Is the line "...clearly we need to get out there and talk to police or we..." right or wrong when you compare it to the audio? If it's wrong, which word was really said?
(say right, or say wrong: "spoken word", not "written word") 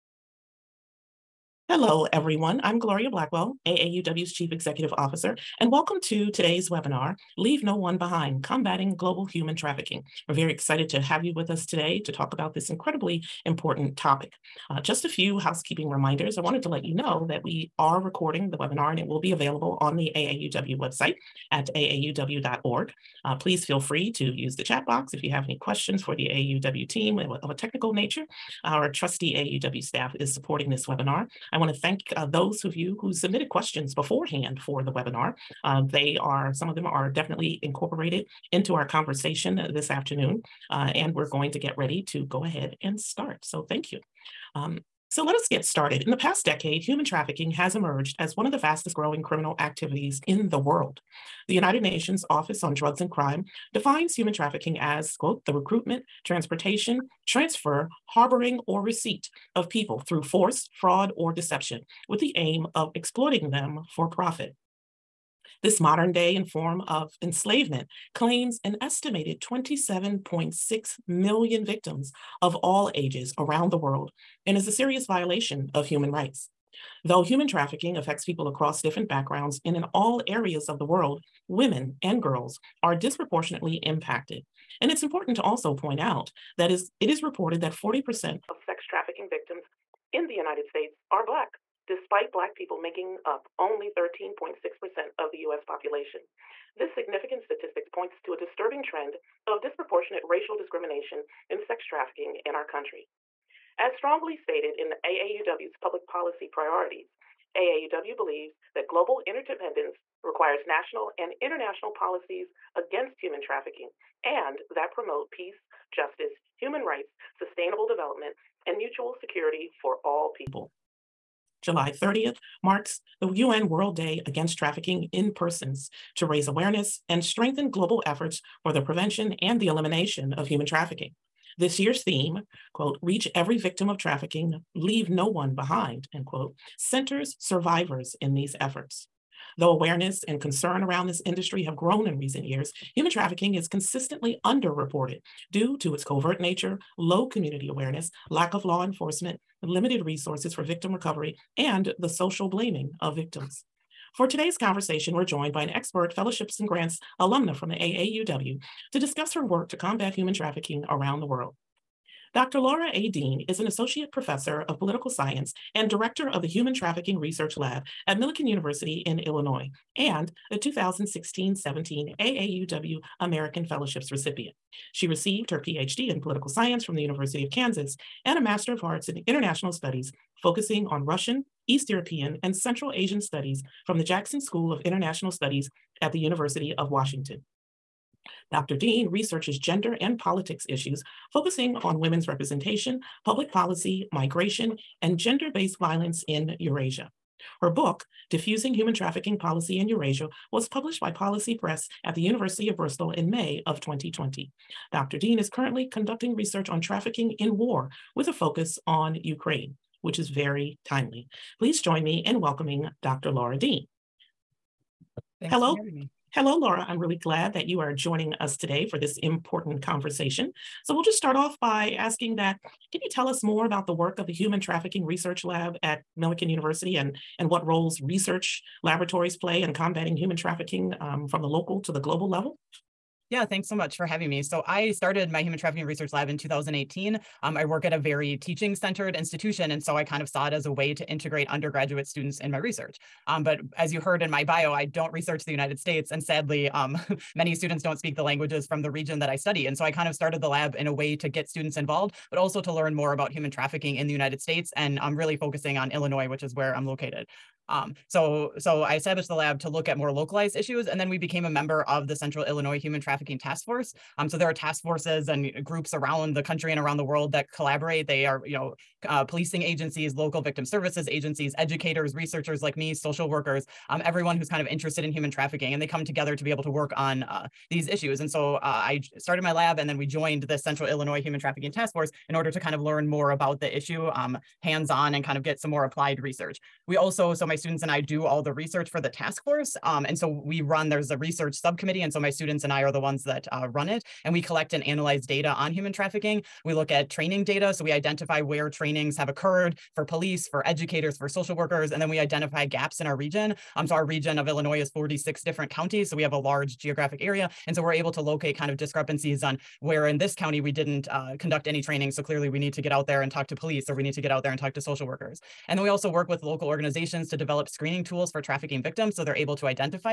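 right.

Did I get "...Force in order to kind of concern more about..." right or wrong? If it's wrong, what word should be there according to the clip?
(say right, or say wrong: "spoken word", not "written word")
wrong: "learn", not "concern".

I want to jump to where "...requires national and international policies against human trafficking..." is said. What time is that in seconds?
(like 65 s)
110 s.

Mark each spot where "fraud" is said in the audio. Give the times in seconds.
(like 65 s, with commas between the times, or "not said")
60 s.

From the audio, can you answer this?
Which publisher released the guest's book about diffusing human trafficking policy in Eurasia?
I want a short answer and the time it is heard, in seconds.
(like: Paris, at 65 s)
Policy Press, at 201 s.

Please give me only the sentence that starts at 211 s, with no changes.
Please join me in welcoming Dr.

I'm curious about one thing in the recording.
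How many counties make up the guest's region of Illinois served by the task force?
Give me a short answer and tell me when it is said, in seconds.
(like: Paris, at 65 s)
46, at 304 s.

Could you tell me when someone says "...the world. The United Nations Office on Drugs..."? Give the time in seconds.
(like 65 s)
50 s.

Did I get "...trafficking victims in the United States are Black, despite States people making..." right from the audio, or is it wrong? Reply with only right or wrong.
wrong.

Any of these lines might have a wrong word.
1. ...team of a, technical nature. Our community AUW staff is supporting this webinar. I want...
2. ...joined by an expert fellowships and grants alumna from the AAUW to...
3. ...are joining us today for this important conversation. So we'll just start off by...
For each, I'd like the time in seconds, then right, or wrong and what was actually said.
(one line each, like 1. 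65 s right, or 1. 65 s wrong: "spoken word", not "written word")
1. 26 s wrong: "trusty", not "community"
2. 155 s right
3. 217 s right.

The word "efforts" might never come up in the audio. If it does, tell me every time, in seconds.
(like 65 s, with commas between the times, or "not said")
128 s, 138 s.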